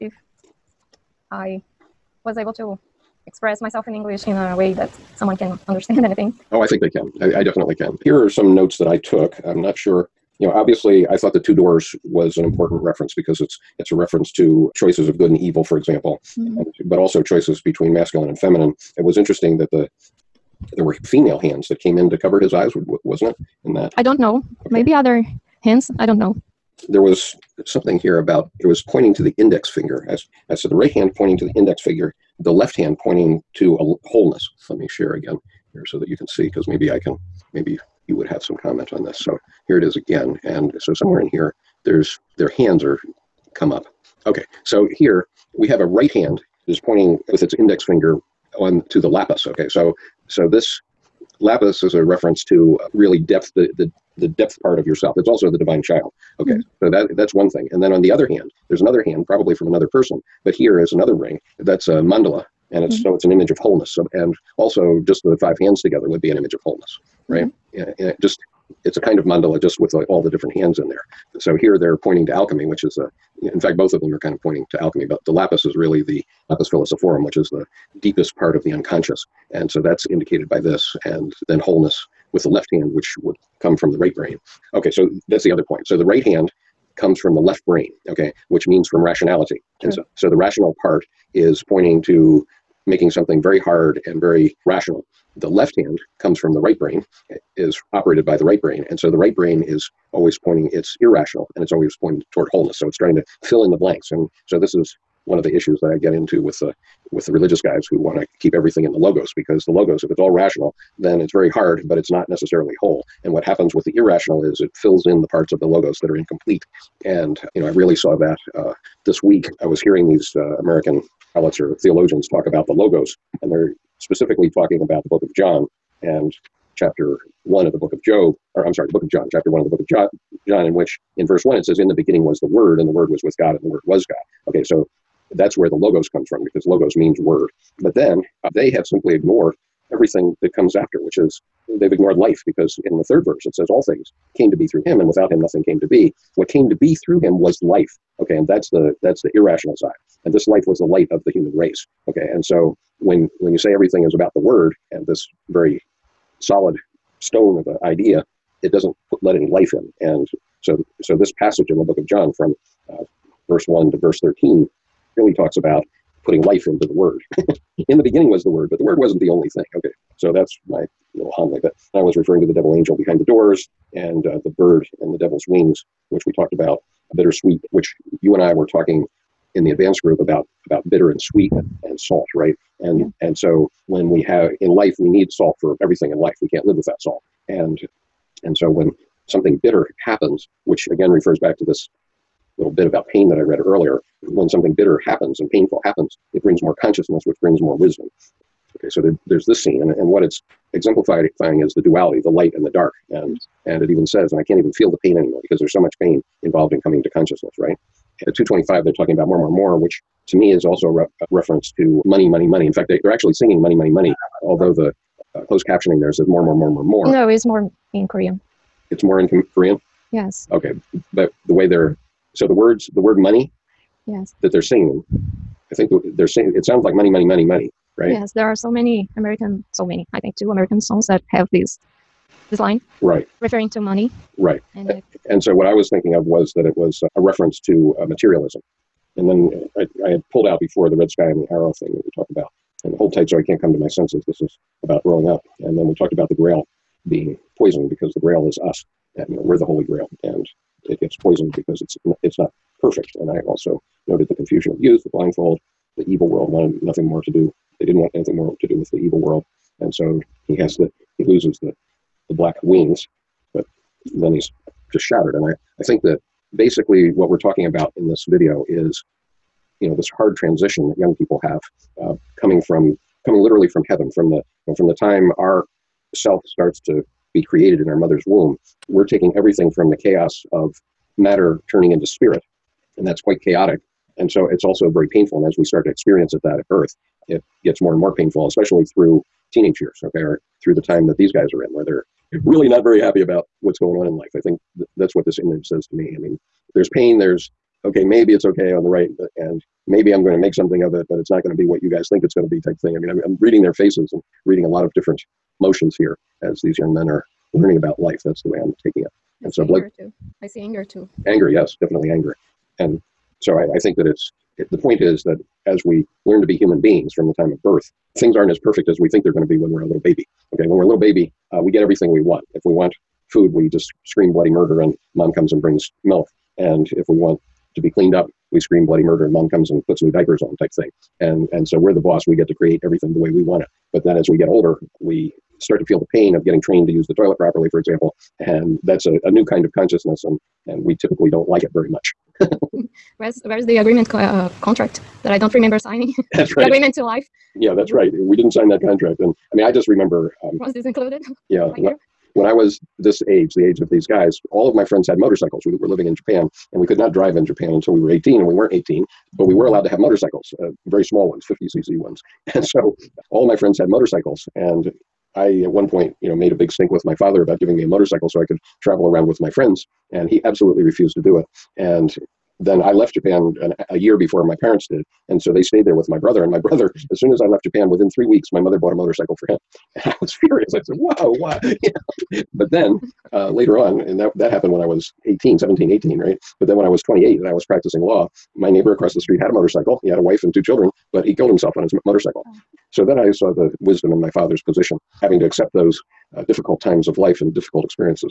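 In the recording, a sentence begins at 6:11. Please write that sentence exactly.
And then I left Japan an, a year before my parents did and so they stayed there with my brother.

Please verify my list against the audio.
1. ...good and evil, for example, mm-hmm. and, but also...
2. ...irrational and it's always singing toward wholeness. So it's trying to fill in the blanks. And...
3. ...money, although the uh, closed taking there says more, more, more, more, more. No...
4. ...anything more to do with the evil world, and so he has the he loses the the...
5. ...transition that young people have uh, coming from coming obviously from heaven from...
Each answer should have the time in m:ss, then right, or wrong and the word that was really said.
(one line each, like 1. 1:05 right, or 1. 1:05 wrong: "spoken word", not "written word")
1. 0:15 right
2. 1:41 wrong: "pointing", not "singing"
3. 3:33 wrong: "captioning", not "taking"
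4. 4:18 right
5. 4:30 wrong: "literally", not "obviously".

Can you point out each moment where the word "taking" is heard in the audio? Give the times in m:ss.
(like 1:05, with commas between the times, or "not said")
4:39, 5:08.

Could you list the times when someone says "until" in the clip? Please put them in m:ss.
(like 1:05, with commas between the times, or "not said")
5:57.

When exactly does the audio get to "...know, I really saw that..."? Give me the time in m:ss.
1:57.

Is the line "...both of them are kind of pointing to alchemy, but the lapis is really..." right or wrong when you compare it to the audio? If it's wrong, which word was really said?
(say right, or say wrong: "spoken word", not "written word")
right.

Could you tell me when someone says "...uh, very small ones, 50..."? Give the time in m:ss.
6:00.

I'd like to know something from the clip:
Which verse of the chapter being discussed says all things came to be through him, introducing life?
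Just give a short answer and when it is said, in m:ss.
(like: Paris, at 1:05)
third verse, at 2:23.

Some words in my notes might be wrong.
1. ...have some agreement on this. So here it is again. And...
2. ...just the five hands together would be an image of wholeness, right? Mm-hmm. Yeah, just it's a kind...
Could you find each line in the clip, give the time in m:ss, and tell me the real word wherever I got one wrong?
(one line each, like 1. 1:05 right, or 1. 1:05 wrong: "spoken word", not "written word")
1. 0:38 wrong: "comment", not "agreement"
2. 1:05 right.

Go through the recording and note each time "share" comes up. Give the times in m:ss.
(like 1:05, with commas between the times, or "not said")
0:34.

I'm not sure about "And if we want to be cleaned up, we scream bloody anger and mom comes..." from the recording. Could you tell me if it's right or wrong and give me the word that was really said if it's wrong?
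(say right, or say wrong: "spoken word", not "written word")
wrong: "murder", not "anger".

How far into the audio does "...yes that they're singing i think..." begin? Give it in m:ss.
3:44.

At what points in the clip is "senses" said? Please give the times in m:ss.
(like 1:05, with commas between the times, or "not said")
4:03.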